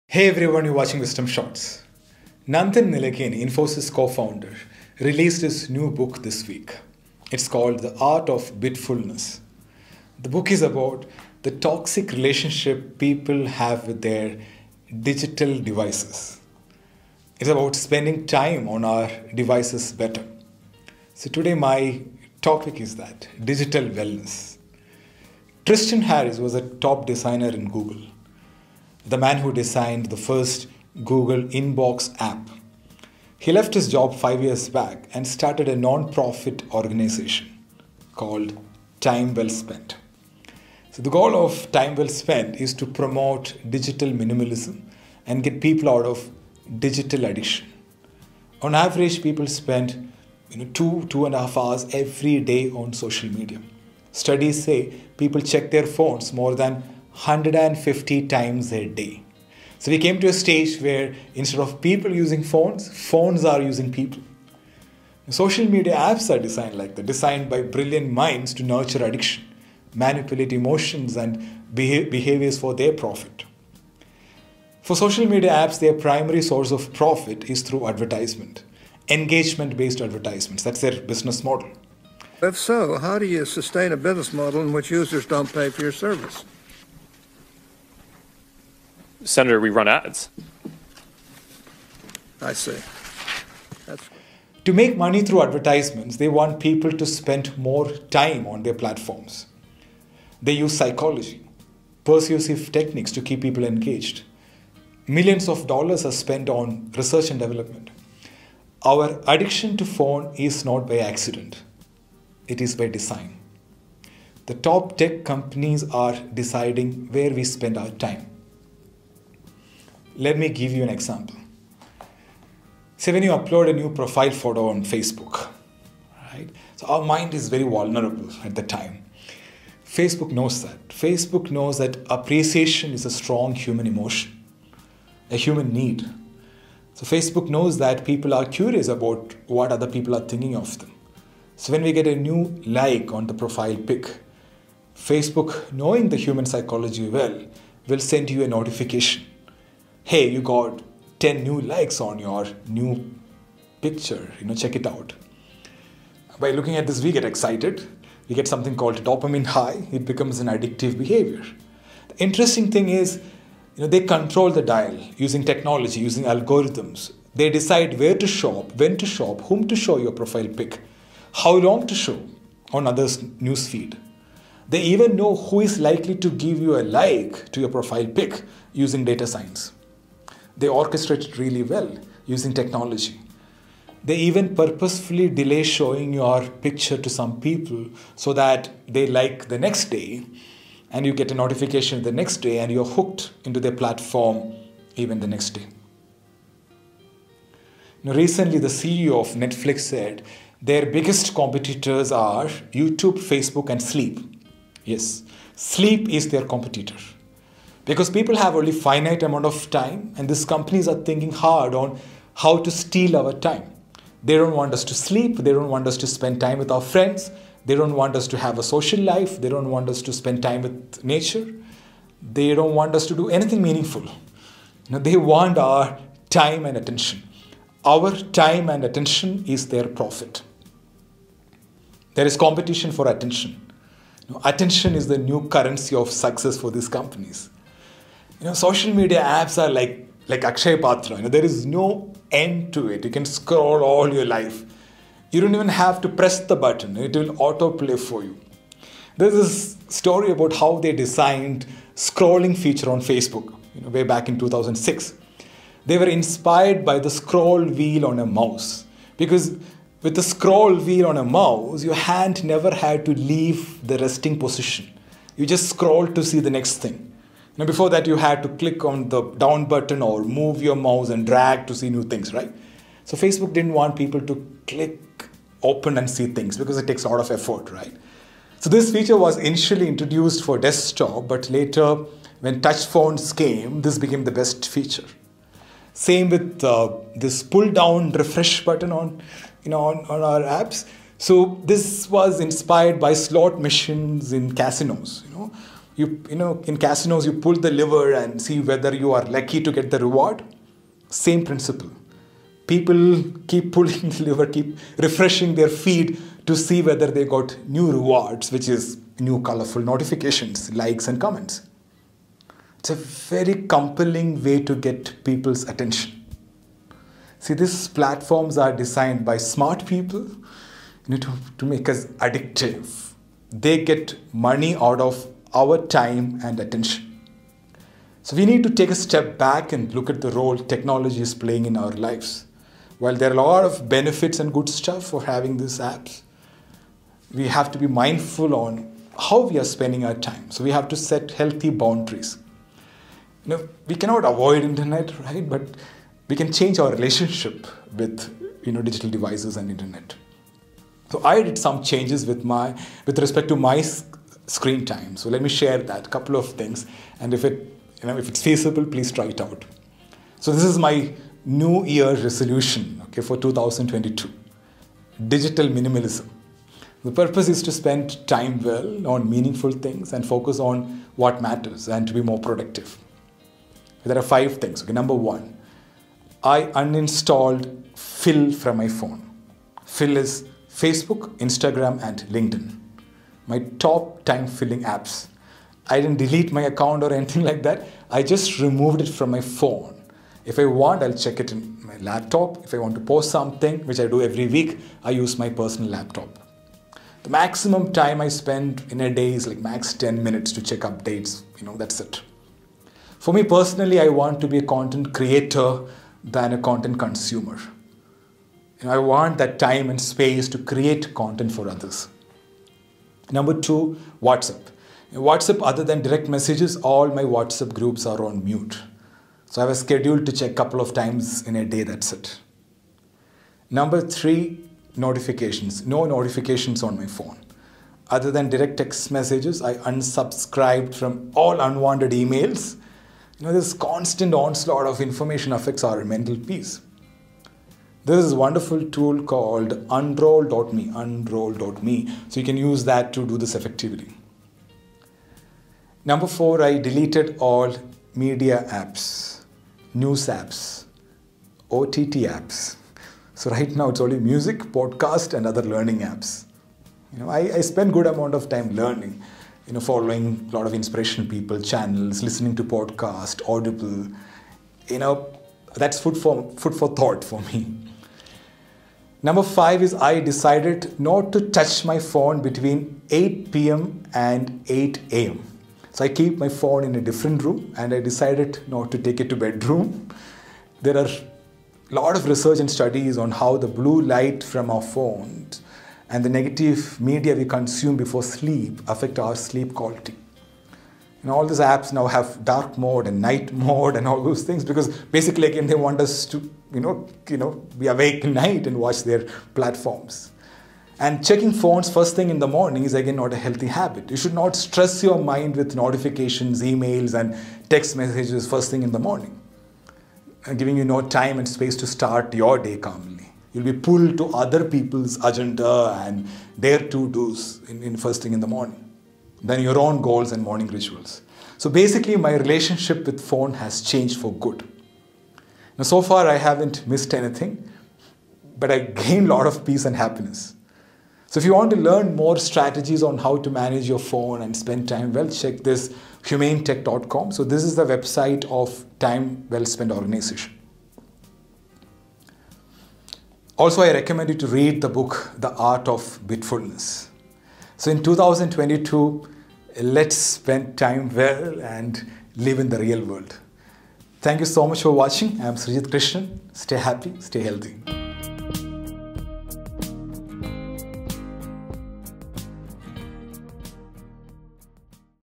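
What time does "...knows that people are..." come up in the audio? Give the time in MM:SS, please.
02:17.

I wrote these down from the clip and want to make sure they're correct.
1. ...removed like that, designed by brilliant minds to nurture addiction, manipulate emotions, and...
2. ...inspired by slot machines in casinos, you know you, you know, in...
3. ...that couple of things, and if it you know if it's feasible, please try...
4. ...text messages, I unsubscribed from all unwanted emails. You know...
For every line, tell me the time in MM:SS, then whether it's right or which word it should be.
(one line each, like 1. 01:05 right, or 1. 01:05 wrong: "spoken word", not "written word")
1. 01:06 wrong: "designed", not "removed"
2. 04:52 right
3. 05:55 right
4. 07:08 right.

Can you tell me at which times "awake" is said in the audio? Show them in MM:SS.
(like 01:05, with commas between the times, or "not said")
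08:17.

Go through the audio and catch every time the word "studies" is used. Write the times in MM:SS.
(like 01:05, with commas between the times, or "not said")
00:54, 08:02.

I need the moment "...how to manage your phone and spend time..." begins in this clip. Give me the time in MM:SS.
08:53.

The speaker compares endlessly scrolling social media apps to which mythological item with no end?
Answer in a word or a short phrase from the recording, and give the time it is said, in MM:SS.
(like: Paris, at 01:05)
Akshay Patra, at 04:00.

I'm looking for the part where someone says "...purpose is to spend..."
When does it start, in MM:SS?
06:07.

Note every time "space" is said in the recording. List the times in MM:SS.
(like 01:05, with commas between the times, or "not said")
06:50, 08:31.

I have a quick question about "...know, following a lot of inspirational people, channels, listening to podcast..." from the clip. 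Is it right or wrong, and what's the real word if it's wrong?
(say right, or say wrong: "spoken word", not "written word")
right.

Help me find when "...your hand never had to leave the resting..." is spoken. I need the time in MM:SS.
04:21.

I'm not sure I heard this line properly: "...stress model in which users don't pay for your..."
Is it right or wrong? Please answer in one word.
wrong.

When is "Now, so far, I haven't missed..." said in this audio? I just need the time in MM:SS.
08:45.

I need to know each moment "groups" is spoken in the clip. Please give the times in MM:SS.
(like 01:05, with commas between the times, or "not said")
06:57.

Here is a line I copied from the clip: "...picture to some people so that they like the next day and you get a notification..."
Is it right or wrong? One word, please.
right.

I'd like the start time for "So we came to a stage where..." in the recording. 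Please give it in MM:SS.
00:59.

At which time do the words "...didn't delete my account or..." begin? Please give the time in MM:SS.
06:25.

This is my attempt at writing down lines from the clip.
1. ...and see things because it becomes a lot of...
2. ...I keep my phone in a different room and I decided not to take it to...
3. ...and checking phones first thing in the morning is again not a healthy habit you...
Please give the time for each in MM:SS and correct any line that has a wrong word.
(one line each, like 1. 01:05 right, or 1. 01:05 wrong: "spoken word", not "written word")
1. 04:35 wrong: "takes", not "becomes"
2. 07:56 right
3. 08:20 right.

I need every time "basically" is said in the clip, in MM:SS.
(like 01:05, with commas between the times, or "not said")
08:15, 08:41.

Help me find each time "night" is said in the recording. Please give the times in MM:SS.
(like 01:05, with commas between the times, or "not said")
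08:13, 08:18.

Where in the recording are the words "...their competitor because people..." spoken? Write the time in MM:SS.
03:26.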